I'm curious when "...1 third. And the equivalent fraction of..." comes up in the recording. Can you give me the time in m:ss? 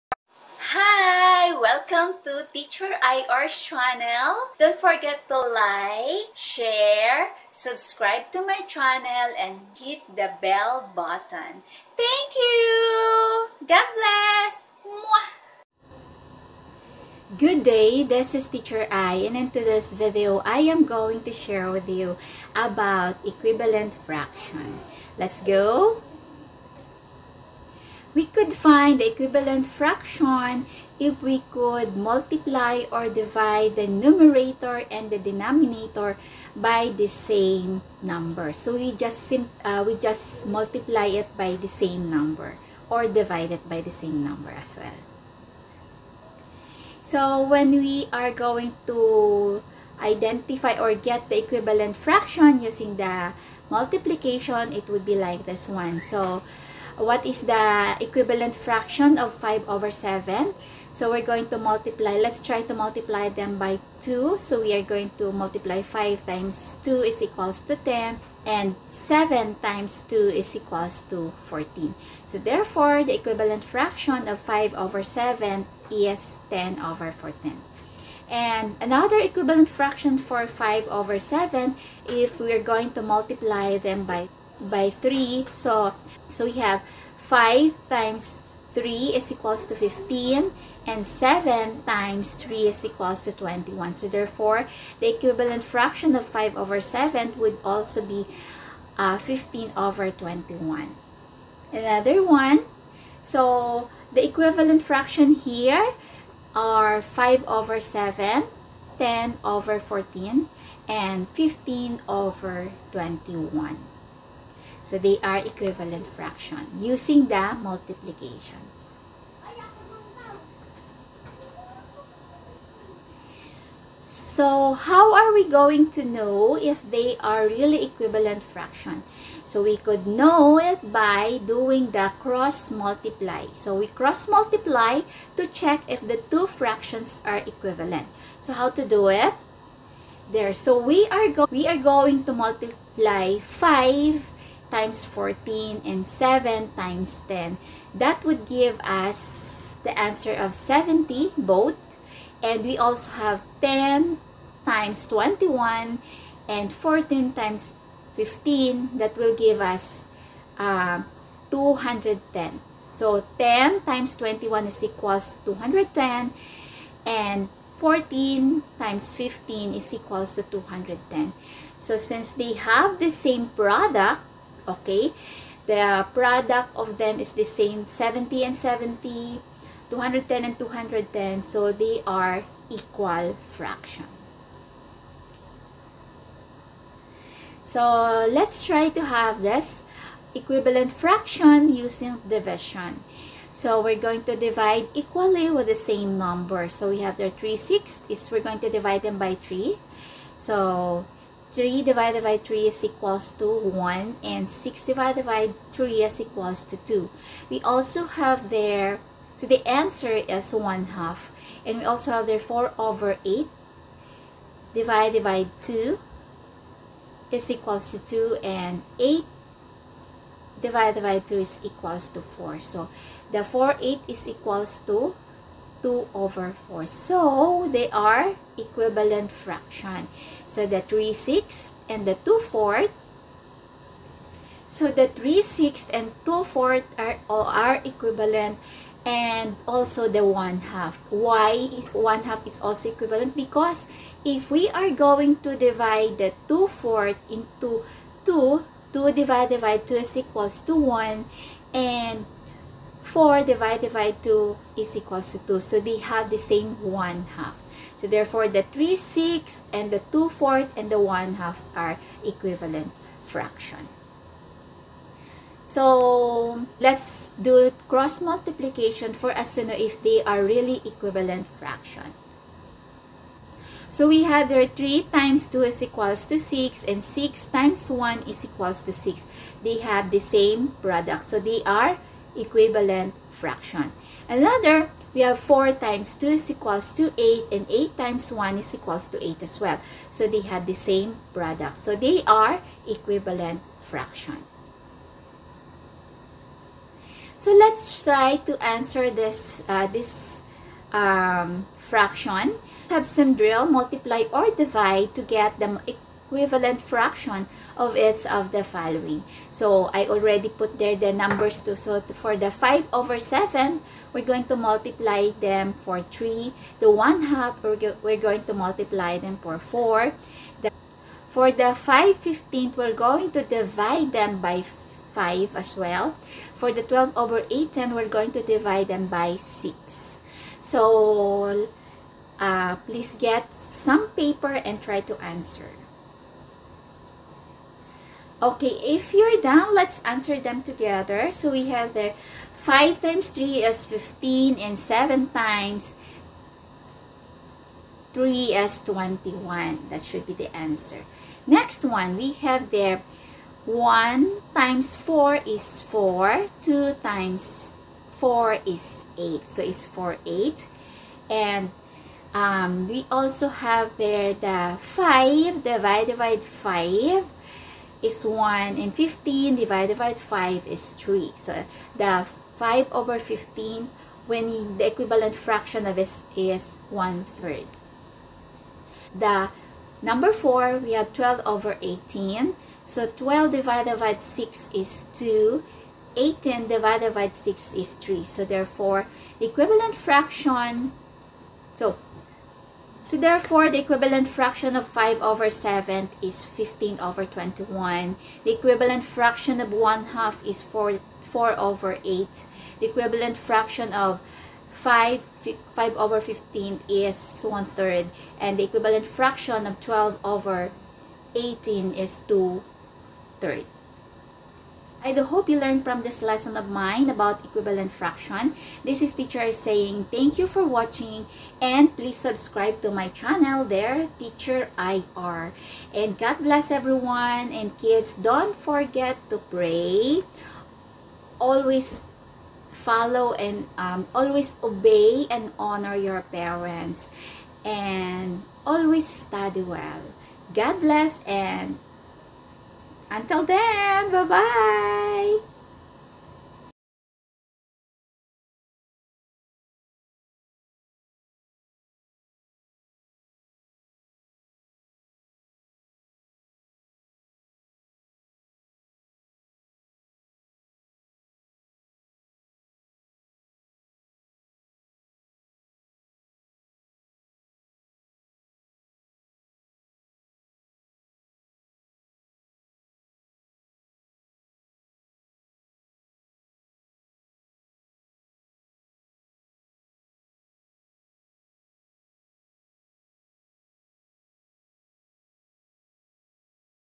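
6:47.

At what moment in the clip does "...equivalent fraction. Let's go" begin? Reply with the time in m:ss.
0:23.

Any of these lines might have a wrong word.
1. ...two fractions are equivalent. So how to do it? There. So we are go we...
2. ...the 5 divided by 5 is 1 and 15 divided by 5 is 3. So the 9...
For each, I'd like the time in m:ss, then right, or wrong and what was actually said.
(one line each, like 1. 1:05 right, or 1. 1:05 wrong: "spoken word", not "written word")
1. 2:16 right
2. 6:04 wrong: "5", not "9".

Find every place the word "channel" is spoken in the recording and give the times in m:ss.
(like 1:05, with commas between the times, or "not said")
0:03, 0:08, 7:03.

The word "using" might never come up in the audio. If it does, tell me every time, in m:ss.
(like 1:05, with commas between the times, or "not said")
0:52, 1:56, 3:11.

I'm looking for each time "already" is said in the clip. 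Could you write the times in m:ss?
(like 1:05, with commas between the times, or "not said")
5:10.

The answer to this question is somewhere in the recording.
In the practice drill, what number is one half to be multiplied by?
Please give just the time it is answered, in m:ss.
5:18.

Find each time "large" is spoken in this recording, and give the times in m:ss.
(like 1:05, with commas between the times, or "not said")
not said.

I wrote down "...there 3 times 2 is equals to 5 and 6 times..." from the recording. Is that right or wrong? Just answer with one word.
wrong.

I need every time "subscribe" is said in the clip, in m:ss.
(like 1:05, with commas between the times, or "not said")
0:07, 7:02.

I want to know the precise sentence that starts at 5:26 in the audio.
For the 12 over 18, we're going to divide them by 6.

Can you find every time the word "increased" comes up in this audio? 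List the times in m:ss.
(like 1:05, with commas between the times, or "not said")
not said.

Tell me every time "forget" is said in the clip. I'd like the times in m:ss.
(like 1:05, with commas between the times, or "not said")
0:04, 7:08.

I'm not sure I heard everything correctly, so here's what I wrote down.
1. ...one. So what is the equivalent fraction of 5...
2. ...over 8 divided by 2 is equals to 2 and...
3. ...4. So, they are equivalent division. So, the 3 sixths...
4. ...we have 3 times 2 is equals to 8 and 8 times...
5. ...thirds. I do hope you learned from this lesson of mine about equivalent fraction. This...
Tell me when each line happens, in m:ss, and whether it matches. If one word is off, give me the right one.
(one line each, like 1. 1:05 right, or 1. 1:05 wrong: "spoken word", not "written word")
1. 0:55 right
2. 3:32 right
3. 3:46 wrong: "fraction", not "division"
4. 4:45 wrong: "4", not "3"
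5. 6:53 right.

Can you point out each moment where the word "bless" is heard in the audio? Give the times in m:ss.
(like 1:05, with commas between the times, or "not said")
0:13, 7:06, 7:20.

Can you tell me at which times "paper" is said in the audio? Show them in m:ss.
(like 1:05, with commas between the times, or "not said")
5:34.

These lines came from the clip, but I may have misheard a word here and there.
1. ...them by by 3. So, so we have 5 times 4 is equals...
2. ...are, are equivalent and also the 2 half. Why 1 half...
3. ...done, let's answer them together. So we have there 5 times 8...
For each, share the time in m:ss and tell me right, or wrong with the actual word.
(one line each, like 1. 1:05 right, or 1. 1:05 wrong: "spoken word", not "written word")
1. 1:23 wrong: "3", not "4"
2. 3:56 wrong: "1", not "2"
3. 5:39 wrong: "3", not "8".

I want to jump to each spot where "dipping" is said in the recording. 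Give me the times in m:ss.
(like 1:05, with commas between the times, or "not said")
not said.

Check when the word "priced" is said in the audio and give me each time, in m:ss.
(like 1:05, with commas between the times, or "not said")
not said.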